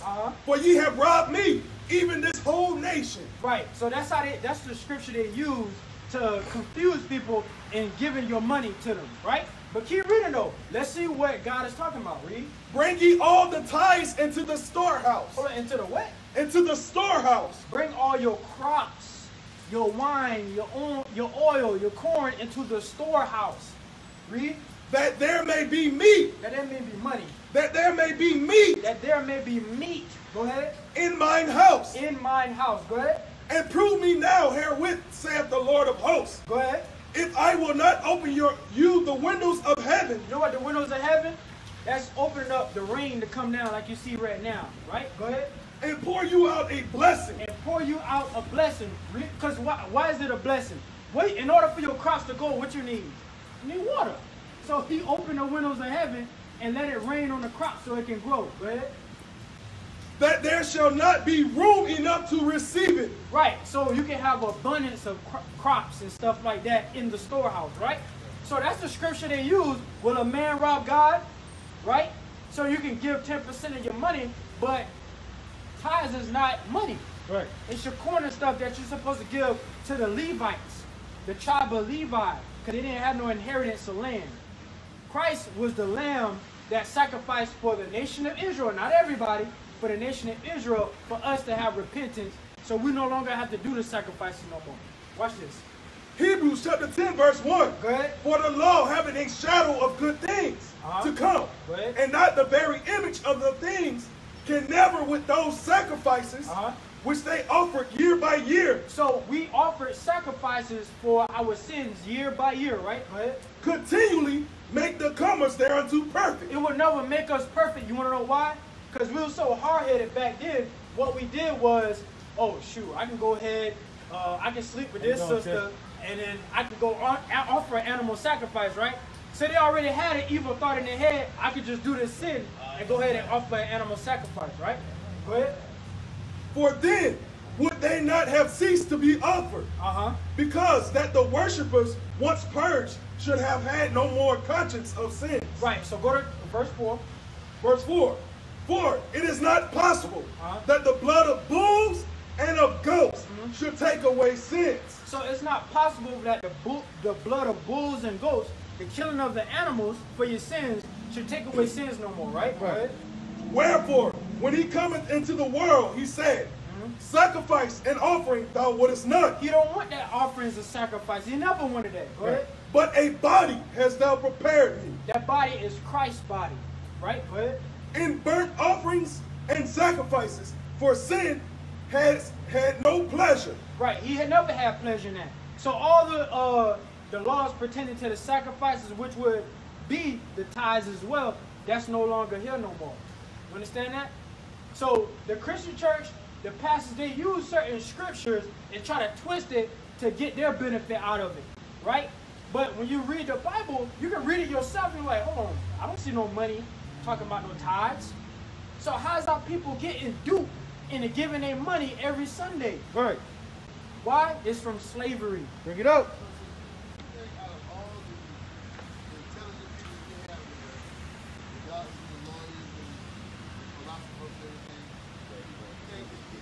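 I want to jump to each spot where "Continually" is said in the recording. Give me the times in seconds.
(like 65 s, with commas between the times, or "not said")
113 s.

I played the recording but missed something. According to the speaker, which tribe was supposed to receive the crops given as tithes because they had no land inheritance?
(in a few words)
Tribe of Levi.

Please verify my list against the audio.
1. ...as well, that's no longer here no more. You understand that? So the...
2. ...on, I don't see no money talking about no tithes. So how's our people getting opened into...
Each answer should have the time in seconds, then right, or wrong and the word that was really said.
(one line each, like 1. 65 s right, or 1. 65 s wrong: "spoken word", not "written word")
1. 190 s right
2. 205 s wrong: "duped", not "opened".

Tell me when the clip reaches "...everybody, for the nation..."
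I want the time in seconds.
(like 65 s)
88 s.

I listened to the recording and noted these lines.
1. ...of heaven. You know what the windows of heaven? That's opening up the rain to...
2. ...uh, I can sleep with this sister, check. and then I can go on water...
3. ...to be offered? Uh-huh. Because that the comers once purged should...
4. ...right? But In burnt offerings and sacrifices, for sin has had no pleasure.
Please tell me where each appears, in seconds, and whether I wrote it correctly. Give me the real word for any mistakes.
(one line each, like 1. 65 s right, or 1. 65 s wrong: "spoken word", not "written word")
1. 39 s right
2. 124 s wrong: "offer", not "water"
3. 138 s wrong: "worshippers", not "comers"
4. 177 s right.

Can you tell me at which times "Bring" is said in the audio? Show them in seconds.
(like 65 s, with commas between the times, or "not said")
12 s, 17 s, 215 s.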